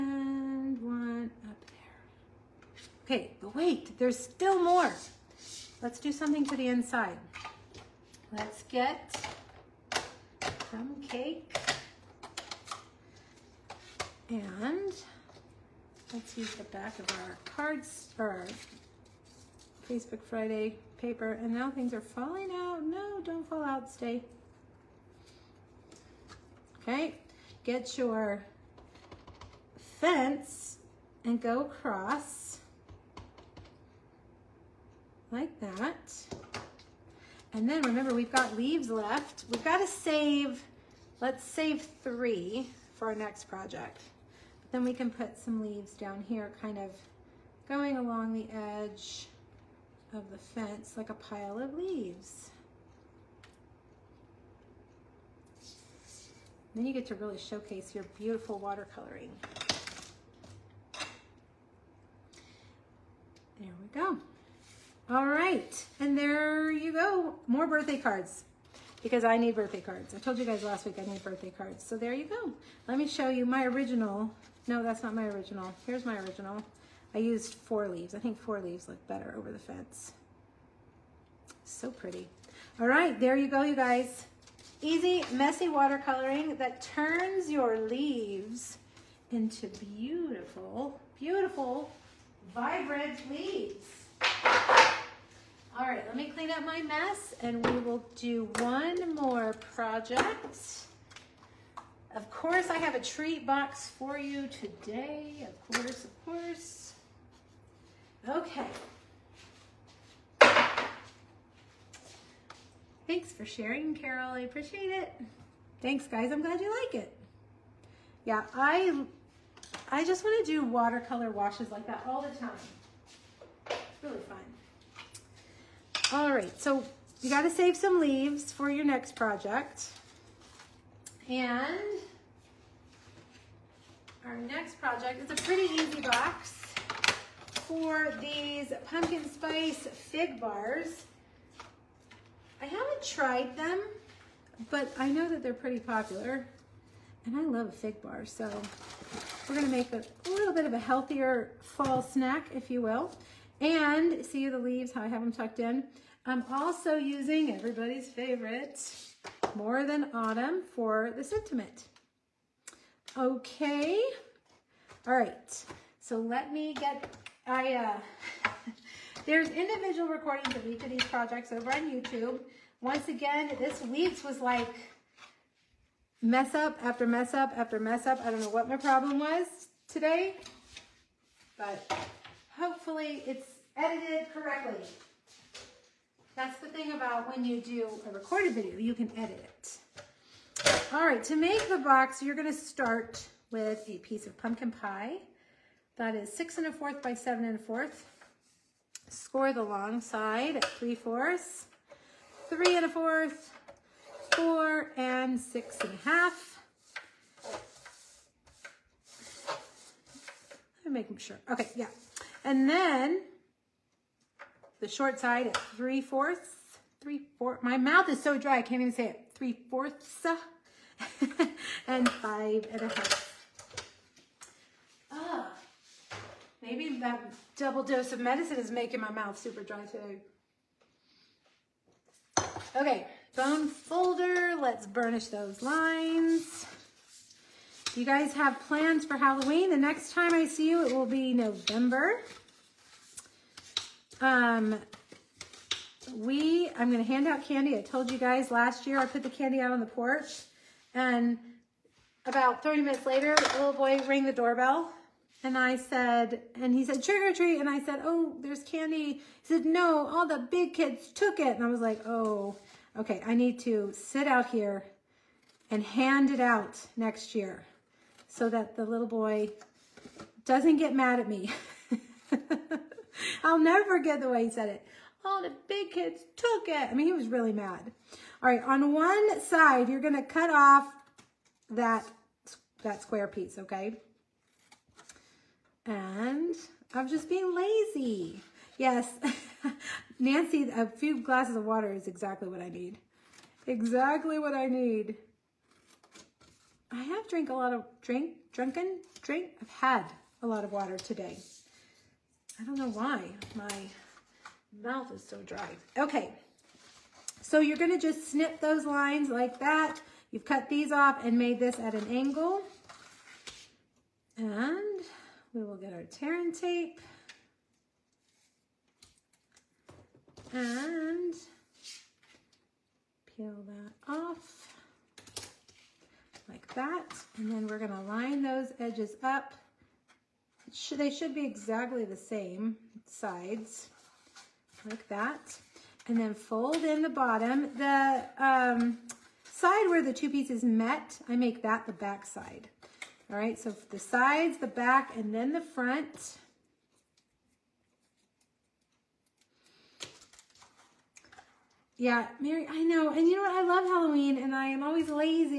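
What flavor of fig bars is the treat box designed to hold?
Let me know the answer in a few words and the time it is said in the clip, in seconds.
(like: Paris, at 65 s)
Pumpkin spice, at 138 s.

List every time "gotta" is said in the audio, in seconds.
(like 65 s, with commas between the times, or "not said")
127 s.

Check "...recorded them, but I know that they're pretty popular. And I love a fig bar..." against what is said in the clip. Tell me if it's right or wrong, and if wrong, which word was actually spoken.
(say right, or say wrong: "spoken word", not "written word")
wrong: "tried", not "recorded".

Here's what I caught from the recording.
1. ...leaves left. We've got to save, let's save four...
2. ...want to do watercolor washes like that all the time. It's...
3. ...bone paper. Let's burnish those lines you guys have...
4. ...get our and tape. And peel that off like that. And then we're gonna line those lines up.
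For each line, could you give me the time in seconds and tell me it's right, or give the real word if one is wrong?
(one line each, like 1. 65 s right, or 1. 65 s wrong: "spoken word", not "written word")
1. 38 s wrong: "three", not "four"
2. 120 s right
3. 233 s wrong: "folder", not "paper"
4. 315 s wrong: "edges", not "lines".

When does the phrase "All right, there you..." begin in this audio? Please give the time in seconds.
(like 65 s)
82 s.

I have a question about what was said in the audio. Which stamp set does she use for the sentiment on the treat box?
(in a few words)
More Than Autumn.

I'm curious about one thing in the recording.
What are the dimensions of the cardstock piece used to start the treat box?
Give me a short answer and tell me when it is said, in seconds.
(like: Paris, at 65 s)
6 1/4 by 7 1/4, at 196 s.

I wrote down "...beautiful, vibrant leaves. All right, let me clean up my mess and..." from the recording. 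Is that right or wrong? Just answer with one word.
right.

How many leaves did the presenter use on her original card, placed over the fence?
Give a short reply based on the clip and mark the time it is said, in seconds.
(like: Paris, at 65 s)
4, at 77 s.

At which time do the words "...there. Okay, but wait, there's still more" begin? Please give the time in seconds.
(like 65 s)
1 s.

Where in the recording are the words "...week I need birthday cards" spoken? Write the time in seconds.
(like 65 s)
70 s.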